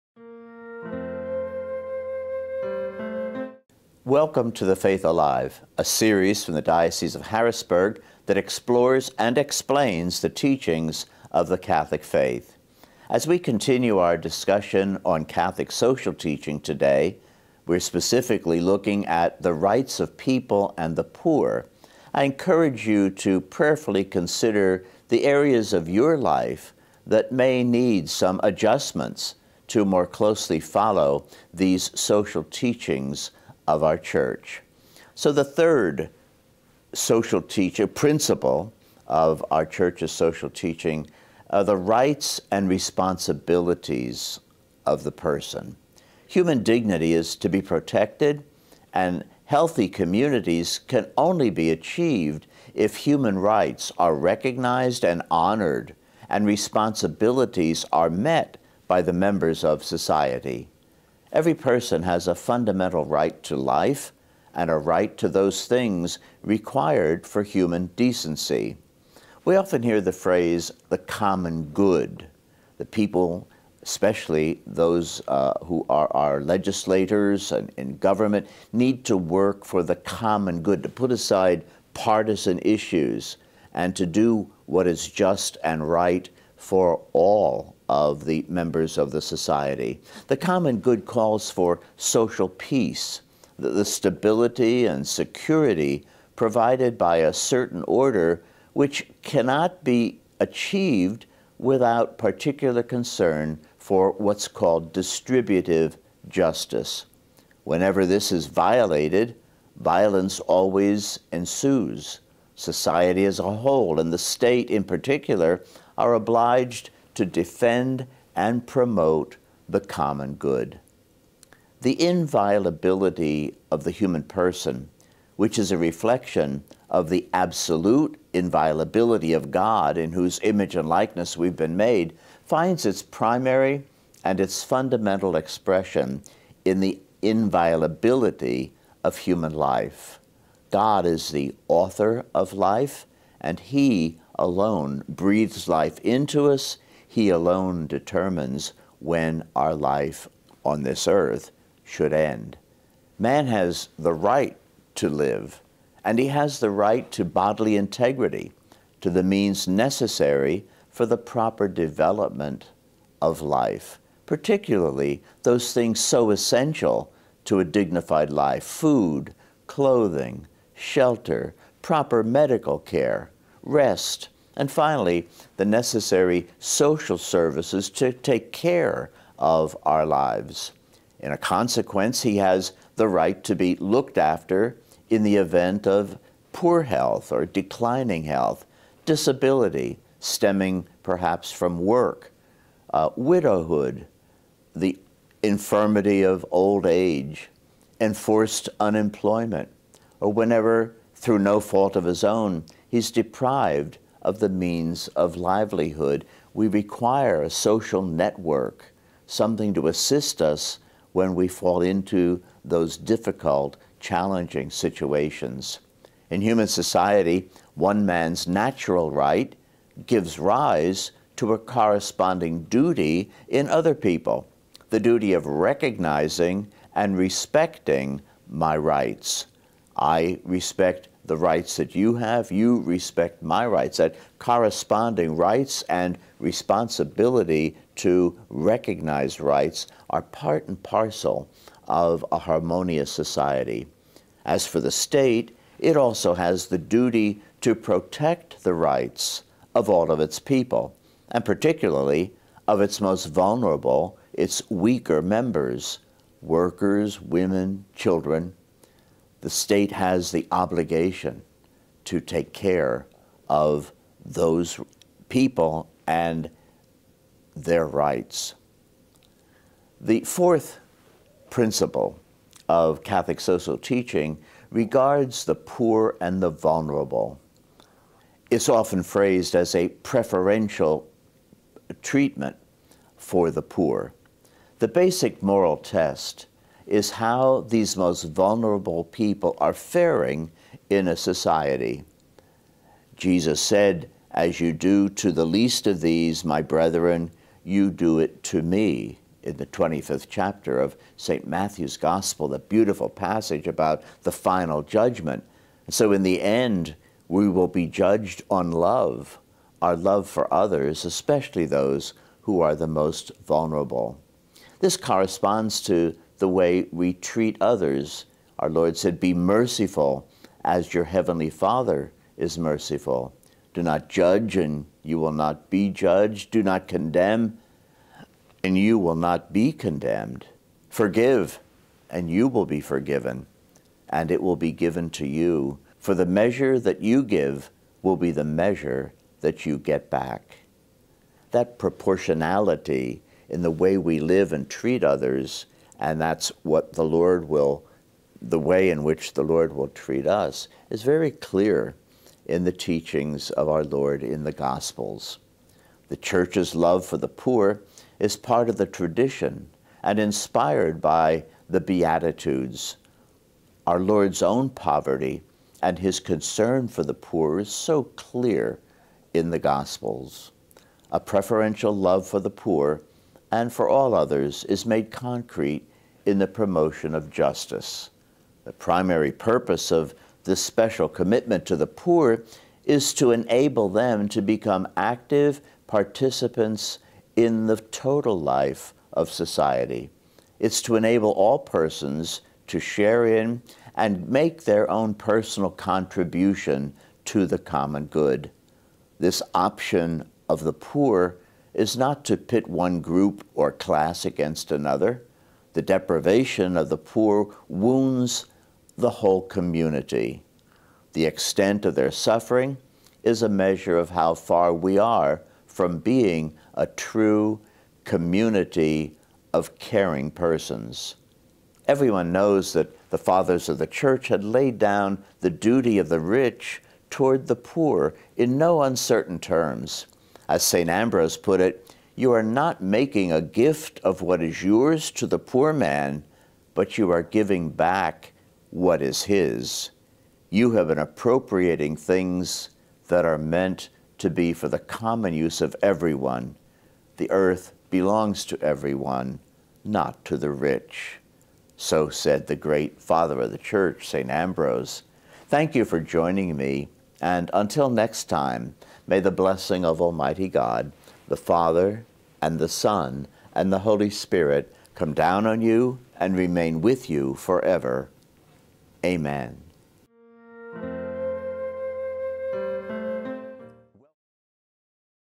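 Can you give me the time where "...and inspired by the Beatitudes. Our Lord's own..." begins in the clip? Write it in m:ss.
6:00.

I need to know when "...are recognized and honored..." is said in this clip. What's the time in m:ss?
0:53.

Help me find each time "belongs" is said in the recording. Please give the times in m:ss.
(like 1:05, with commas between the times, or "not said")
7:27.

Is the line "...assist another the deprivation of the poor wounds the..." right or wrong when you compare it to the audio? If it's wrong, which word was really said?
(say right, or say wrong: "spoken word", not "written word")
wrong: "against", not "assist".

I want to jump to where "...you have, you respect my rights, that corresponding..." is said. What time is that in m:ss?
3:51.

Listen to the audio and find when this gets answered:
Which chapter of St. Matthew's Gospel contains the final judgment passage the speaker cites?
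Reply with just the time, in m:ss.
4:59.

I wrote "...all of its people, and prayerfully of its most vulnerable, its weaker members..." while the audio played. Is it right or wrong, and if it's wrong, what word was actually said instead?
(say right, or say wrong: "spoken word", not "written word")
wrong: "particularly", not "prayerfully".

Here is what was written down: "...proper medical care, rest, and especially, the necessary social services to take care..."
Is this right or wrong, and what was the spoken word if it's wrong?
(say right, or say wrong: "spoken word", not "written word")
wrong: "finally", not "especially".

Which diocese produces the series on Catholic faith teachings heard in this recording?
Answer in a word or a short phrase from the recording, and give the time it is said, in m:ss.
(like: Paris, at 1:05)
Diocese of Harrisburg, at 0:06.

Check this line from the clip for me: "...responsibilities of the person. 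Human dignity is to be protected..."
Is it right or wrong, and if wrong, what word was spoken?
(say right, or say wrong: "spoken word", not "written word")
right.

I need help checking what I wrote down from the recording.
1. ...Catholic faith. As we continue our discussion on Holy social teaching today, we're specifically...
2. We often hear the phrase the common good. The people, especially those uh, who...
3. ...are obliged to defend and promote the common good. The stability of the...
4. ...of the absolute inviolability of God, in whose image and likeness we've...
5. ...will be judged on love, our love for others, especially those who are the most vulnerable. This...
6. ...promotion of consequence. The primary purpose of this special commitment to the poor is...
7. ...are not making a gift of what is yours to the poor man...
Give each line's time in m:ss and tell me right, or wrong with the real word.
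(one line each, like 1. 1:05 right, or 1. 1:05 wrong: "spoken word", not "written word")
1. 0:11 wrong: "Catholic", not "Holy"
2. 1:09 right
3. 1:55 wrong: "inviolability", not "stability"
4. 2:06 right
5. 5:07 right
6. 6:16 wrong: "justice", not "consequence"
7. 7:12 right.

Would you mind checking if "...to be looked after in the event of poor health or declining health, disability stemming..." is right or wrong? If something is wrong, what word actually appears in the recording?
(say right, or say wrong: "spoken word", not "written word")
right.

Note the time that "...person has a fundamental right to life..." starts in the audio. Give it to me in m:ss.
1:01.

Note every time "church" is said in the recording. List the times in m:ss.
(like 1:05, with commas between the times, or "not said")
0:33, 0:39, 5:56, 7:03, 7:33.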